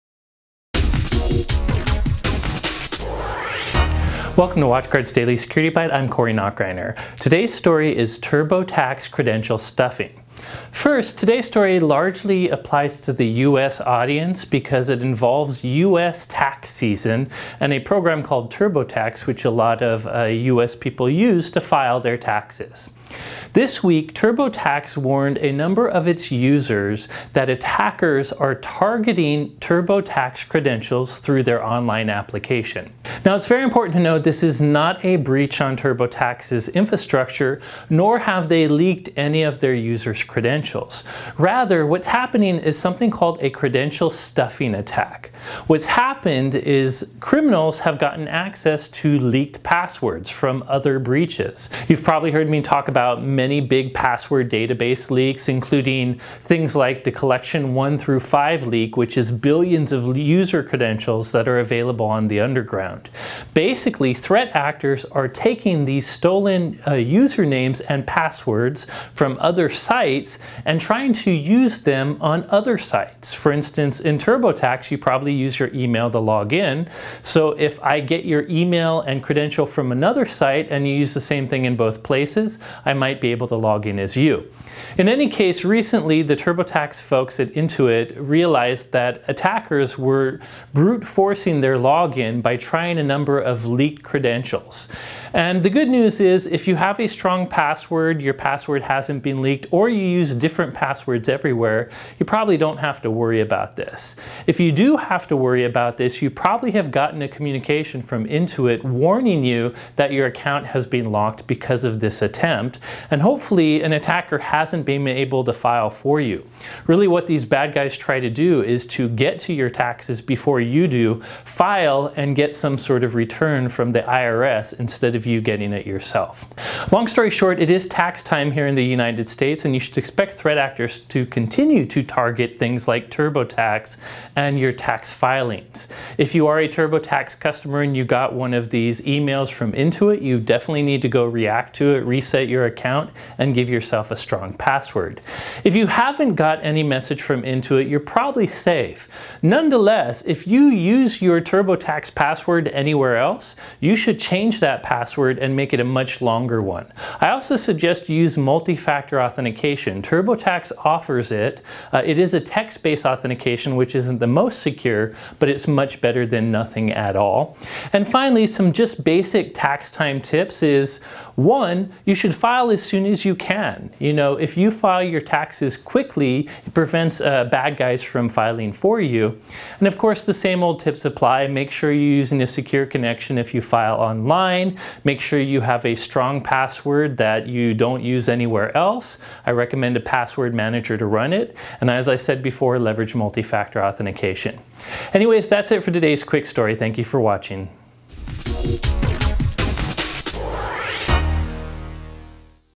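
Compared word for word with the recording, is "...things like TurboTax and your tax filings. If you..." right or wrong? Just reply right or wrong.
right.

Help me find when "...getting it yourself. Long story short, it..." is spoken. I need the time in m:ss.
2:05.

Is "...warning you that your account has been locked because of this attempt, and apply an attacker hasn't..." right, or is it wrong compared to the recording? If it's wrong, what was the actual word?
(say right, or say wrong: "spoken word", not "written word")
wrong: "hopefully", not "apply".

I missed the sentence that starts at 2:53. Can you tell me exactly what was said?
You know, if you file your taxes quickly, it prevents uh, bad guys from filing for you.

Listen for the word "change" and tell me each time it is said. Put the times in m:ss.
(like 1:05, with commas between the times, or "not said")
2:34.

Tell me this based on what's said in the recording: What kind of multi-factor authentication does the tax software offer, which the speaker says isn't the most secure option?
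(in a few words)
Text-based.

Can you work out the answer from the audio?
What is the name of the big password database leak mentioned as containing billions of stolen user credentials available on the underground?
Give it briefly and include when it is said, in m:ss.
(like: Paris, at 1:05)
Collection 1 through 5, at 0:57.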